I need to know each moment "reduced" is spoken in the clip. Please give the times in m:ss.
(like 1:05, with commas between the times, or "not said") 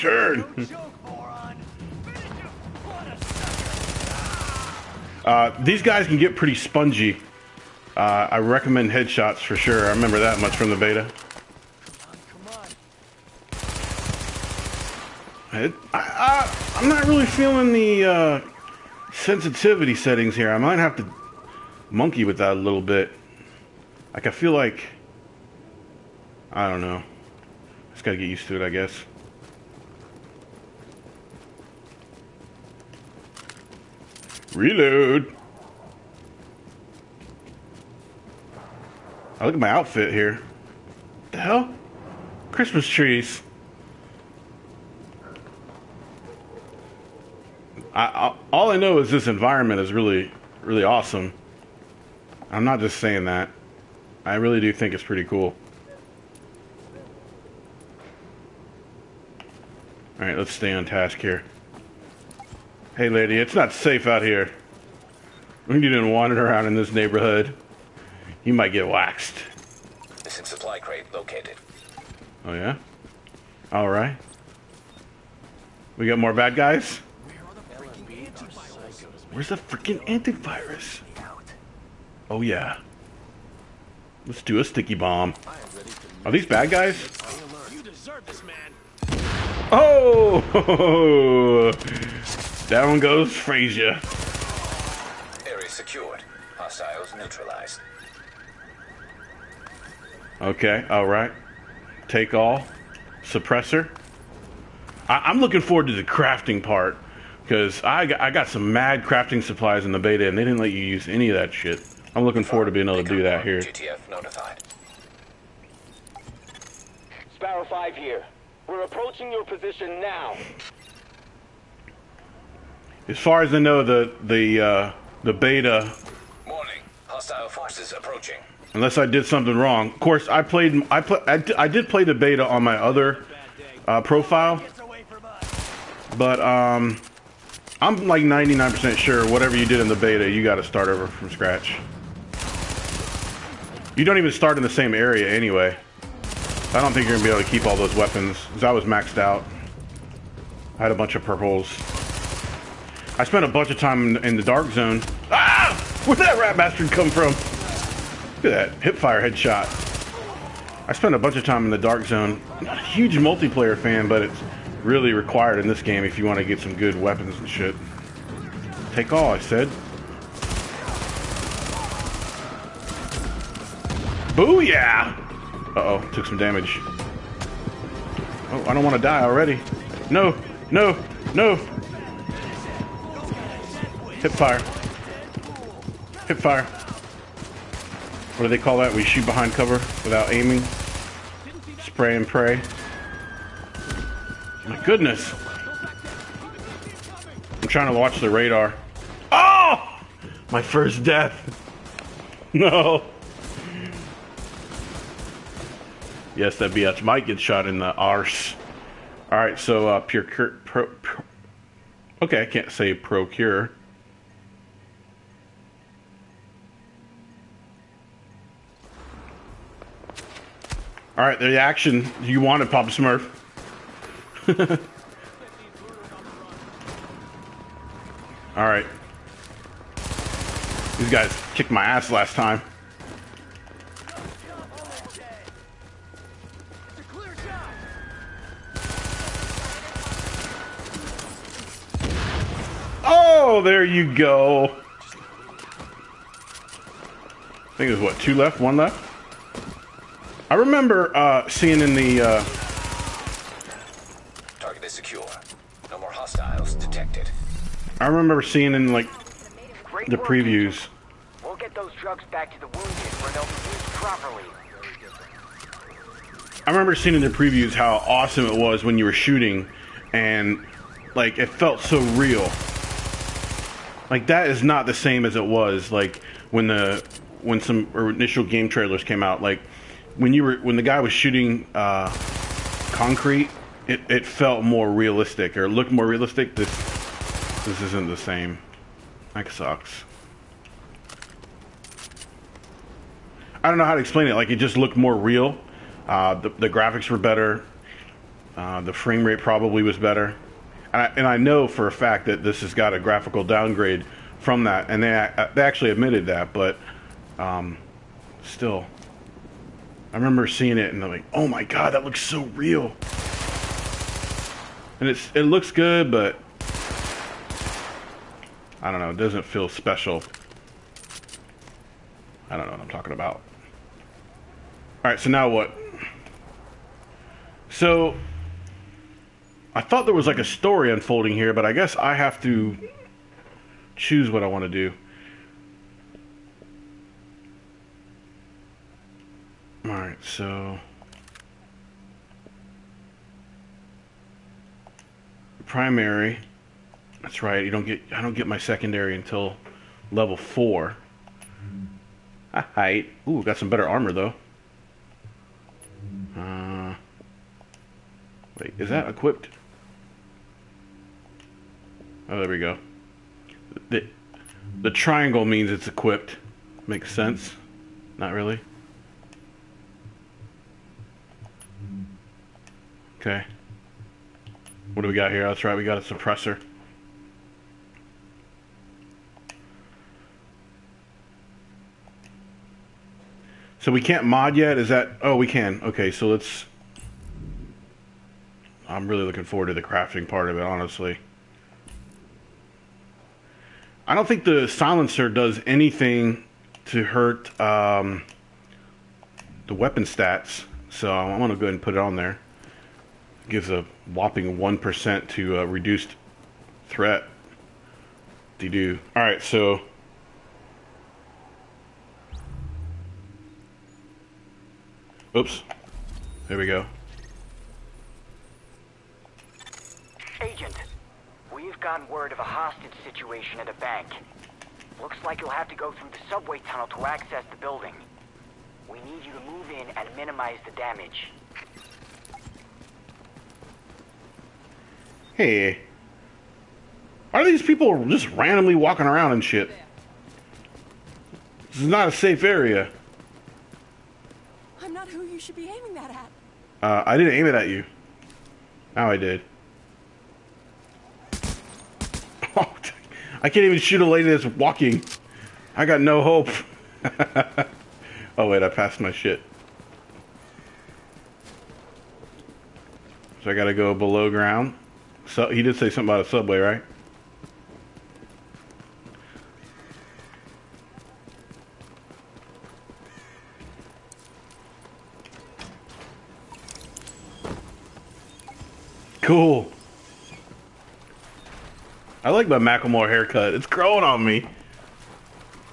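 6:45.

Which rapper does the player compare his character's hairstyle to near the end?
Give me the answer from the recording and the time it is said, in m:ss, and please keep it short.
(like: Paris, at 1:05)
Macklemore, at 8:02.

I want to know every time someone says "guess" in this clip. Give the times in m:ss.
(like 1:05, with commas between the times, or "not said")
0:28, 5:31.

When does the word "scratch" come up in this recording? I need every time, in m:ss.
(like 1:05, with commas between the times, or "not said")
2:21.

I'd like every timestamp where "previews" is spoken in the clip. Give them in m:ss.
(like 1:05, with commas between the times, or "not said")
4:20, 4:27.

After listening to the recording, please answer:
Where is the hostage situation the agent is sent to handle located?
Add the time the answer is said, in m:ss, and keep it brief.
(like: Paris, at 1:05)
A bank, at 7:03.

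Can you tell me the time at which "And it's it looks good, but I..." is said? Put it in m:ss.
5:14.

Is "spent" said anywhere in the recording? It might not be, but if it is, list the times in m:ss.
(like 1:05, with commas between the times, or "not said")
2:33, 2:40.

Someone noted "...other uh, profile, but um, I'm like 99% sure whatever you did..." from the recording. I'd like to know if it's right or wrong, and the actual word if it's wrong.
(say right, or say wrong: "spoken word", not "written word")
right.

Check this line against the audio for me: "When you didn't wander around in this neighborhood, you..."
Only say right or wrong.
right.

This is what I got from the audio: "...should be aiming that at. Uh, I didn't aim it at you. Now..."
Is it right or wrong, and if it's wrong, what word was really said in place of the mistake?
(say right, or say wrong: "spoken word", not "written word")
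right.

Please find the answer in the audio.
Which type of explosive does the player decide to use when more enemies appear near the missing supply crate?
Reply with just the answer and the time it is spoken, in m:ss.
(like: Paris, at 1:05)
Sticky bomb, at 1:24.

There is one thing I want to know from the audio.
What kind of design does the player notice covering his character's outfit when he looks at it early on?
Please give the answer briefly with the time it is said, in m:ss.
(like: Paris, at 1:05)
Christmas trees, at 0:42.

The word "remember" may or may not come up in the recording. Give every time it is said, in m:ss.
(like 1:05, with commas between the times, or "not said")
0:09, 4:10, 4:18, 4:26, 5:10.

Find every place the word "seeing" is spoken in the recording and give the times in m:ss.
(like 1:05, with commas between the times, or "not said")
4:11, 4:18, 4:26, 5:10.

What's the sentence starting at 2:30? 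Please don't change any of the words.
I had a bunch of purples.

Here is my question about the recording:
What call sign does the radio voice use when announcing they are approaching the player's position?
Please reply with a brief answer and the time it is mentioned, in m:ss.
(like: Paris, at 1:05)
Sparrow 5, at 1:57.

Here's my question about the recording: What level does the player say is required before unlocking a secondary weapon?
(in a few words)
Level 4.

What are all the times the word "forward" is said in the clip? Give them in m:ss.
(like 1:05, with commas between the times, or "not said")
1:45, 1:52, 6:29.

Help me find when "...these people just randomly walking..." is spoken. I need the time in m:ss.
7:17.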